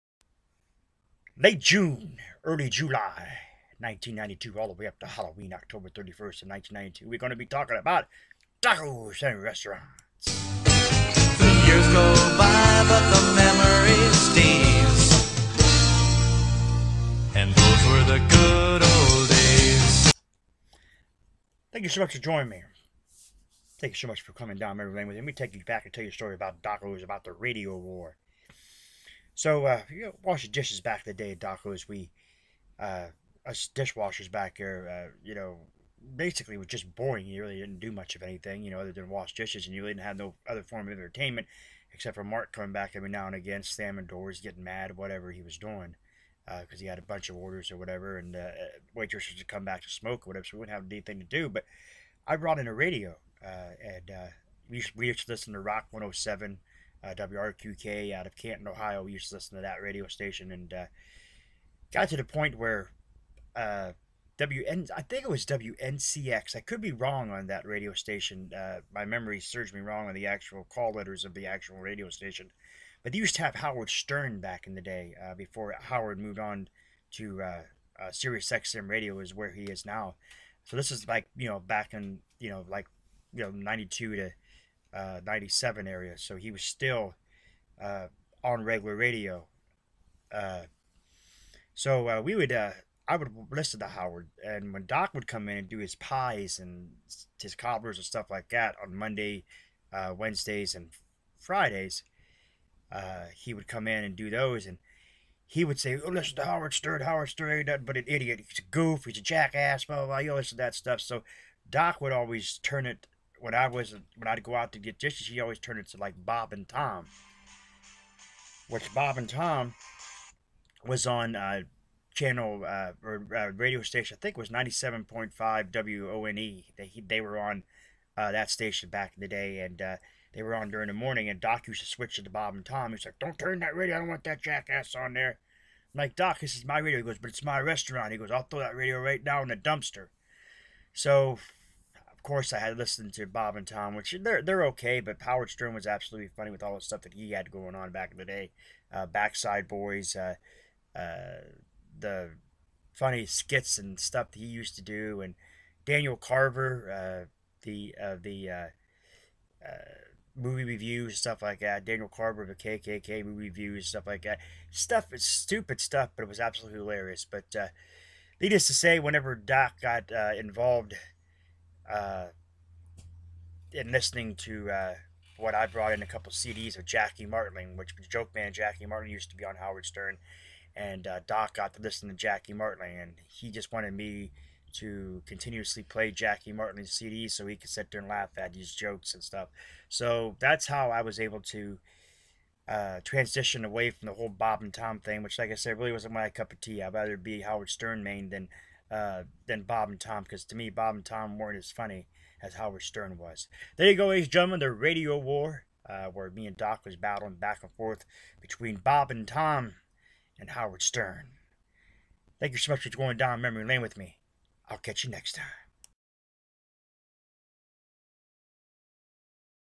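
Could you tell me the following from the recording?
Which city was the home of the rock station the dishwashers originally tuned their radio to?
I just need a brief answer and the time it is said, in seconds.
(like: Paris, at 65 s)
Canton, Ohio, at 58 s.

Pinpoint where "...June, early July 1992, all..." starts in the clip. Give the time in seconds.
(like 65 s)
1 s.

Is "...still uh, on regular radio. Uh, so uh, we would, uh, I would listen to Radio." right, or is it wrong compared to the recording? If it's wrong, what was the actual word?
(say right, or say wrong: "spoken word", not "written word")
wrong: "Howard", not "Radio".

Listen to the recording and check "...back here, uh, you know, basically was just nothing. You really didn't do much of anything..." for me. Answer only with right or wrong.
wrong.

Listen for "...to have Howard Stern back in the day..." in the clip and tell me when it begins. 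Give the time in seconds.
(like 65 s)
73 s.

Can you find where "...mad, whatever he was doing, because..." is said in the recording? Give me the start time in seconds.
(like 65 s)
44 s.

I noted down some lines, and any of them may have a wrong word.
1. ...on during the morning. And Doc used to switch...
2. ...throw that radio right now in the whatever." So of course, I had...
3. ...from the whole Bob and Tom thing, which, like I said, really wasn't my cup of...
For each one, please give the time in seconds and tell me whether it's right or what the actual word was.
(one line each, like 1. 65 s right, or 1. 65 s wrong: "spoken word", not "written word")
1. 130 s right
2. 138 s wrong: "dumpster", not "whatever"
3. 193 s right.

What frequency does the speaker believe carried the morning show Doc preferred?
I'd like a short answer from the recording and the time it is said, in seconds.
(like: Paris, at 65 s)
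97.5, at 124 s.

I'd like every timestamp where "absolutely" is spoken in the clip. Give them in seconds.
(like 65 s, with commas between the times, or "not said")
145 s, 166 s.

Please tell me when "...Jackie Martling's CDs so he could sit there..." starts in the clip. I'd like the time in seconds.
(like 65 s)
186 s.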